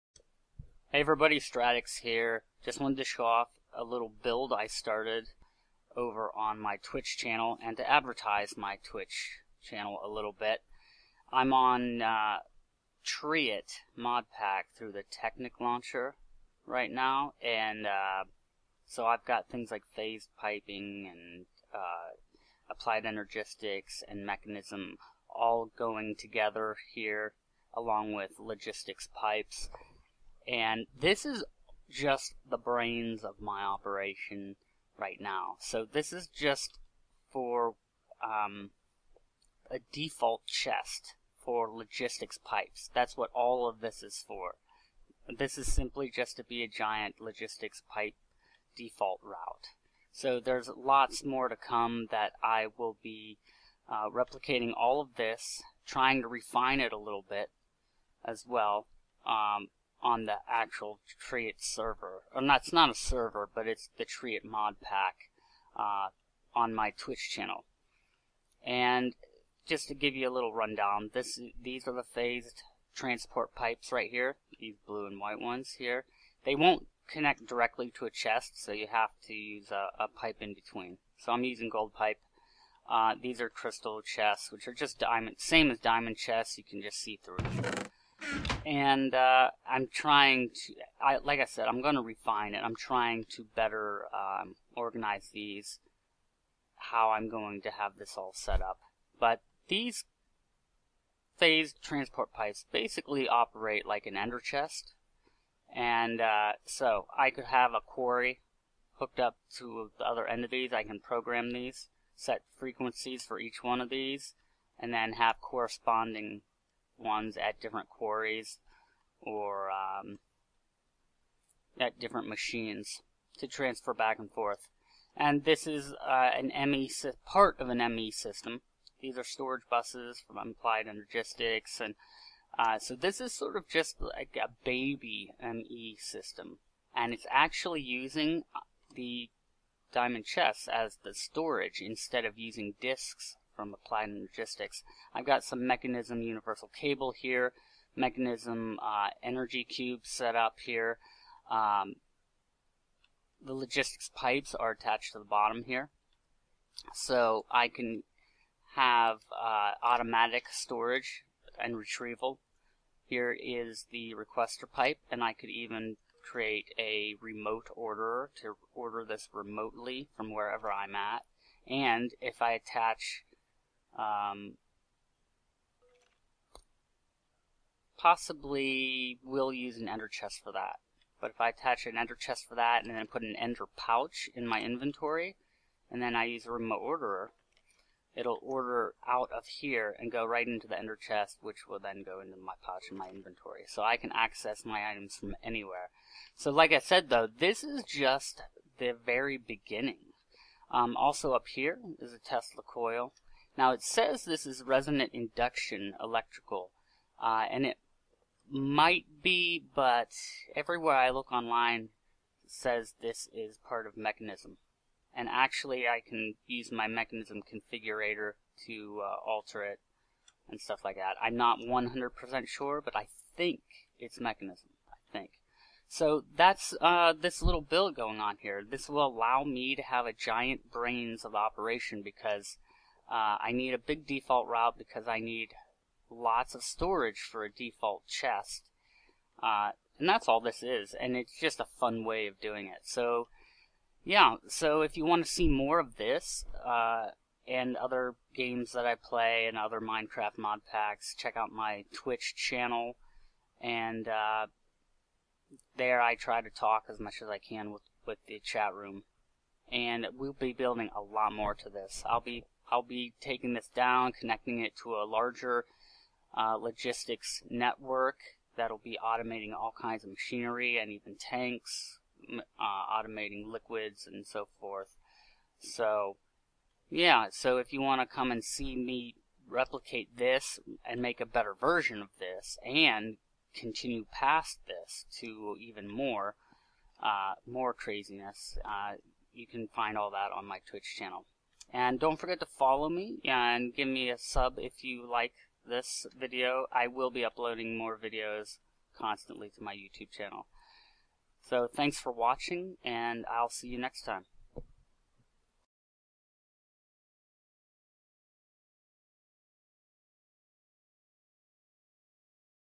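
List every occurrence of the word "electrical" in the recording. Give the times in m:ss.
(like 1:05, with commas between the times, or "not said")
3:26.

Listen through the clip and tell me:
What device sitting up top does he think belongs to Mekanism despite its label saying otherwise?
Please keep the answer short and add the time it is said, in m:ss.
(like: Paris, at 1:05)
Tesla coil, at 3:22.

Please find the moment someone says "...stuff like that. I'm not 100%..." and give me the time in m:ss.
3:40.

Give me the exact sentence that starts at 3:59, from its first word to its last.
Uh, and that's all this is, and it's just a fun way of doing it.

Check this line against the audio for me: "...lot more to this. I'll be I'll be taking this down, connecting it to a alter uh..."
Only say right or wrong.
wrong.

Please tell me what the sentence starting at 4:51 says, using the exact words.
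And don't forget to follow me and give me a sub if you like this video.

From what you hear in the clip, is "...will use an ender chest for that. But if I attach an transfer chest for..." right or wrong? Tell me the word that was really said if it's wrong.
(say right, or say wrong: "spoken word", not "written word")
wrong: "ender", not "transfer".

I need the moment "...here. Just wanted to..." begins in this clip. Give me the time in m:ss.
0:02.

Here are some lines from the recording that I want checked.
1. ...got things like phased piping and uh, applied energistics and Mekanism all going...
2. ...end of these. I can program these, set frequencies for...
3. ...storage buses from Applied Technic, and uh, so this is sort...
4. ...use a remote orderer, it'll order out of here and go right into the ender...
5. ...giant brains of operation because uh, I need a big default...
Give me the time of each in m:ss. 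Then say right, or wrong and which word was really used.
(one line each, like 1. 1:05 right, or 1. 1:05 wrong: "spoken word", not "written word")
1. 0:19 right
2. 1:50 right
3. 2:09 wrong: "Logistics", not "Technic"
4. 3:06 right
5. 3:50 right.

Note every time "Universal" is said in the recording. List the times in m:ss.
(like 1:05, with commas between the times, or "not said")
2:26.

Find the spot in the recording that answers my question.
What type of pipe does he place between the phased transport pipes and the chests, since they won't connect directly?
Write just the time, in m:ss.
1:21.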